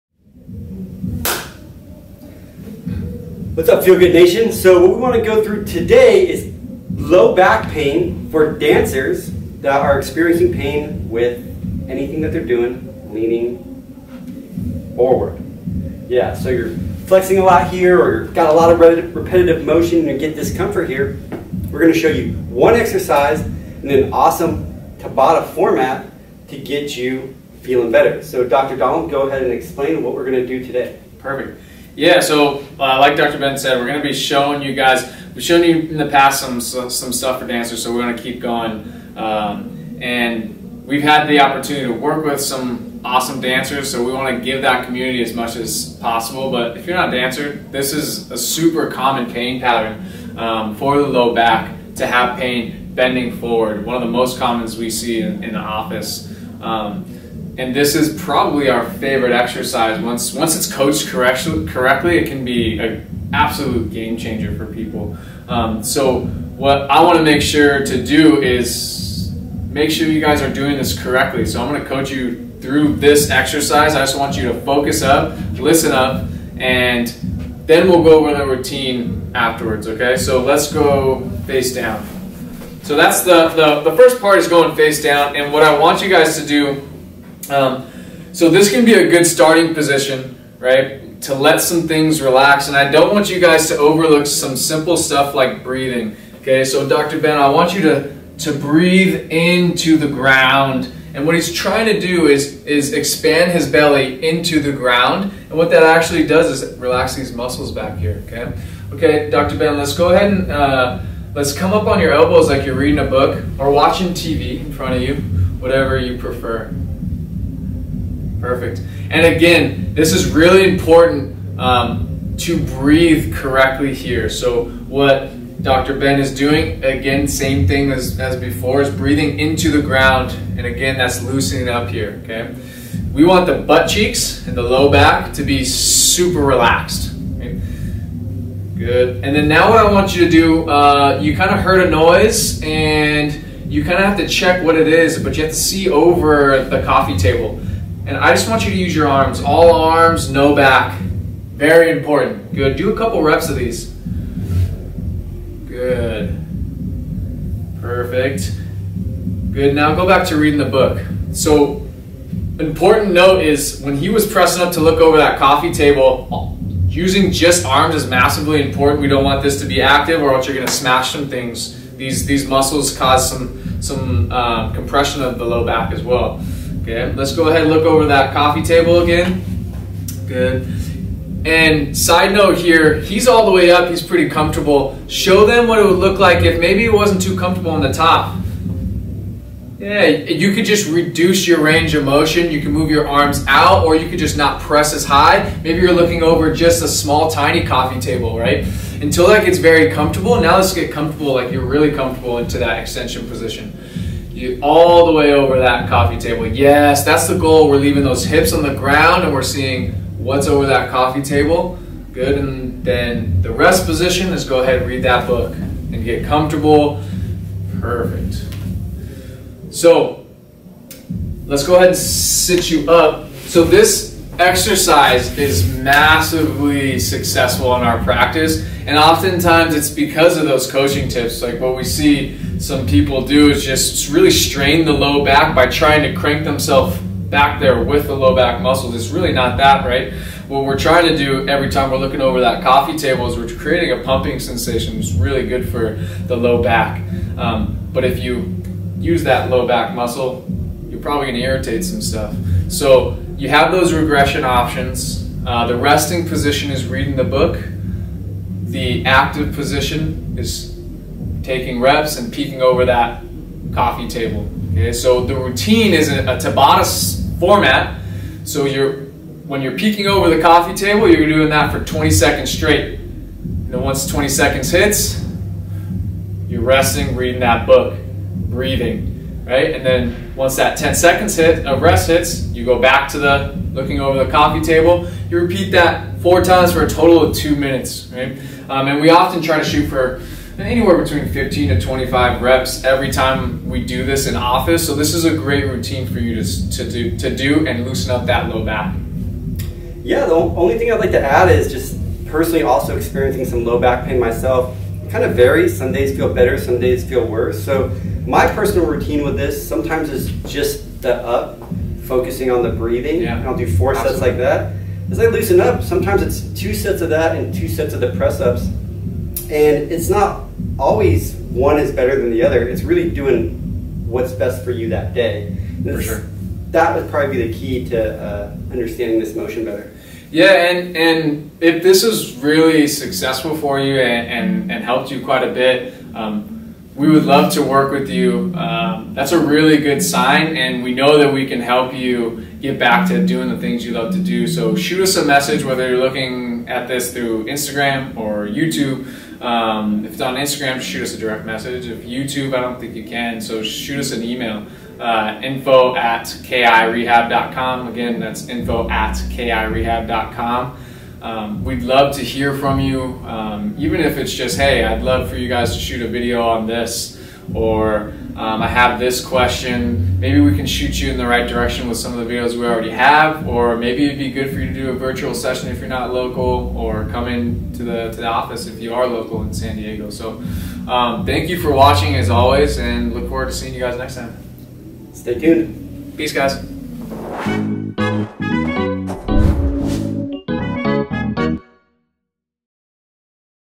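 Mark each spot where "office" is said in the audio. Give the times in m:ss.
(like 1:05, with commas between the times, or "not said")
0:55, 4:54, 6:18.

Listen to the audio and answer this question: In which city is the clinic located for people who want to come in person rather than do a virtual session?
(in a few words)
San Diego.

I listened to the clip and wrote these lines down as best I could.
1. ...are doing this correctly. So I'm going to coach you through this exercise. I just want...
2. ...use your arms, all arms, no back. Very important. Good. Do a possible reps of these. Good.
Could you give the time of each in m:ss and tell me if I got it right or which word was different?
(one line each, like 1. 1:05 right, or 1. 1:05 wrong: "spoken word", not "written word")
1. 1:10 right
2. 2:28 wrong: "couple", not "possible".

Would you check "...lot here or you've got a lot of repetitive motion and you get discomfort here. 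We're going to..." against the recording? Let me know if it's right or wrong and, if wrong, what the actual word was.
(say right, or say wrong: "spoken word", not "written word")
right.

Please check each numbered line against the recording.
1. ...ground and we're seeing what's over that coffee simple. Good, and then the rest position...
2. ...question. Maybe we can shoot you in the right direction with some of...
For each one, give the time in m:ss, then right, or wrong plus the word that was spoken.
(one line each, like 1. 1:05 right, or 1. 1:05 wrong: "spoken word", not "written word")
1. 3:28 wrong: "table", not "simple"
2. 6:09 right.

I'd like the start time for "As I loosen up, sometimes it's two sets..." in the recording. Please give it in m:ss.
5:15.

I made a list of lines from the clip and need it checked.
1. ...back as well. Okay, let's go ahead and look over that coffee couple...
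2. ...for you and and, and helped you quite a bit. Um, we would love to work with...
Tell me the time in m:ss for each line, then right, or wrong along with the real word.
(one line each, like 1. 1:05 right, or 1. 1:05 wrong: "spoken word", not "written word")
1. 2:55 wrong: "table", not "couple"
2. 5:33 right.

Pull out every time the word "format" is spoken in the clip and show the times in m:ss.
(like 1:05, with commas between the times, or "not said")
0:25, 4:27.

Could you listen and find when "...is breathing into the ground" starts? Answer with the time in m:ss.
2:08.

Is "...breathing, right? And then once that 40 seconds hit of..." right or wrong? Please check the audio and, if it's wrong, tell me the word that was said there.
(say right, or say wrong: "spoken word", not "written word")
wrong: "10", not "40".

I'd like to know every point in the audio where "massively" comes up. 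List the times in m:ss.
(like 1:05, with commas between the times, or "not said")
2:48, 3:45.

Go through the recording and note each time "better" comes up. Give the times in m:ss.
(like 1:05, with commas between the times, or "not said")
0:27, 5:06, 5:21, 5:29.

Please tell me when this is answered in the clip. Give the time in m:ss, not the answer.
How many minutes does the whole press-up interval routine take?
4:47.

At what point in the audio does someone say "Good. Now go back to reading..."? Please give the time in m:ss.
2:39.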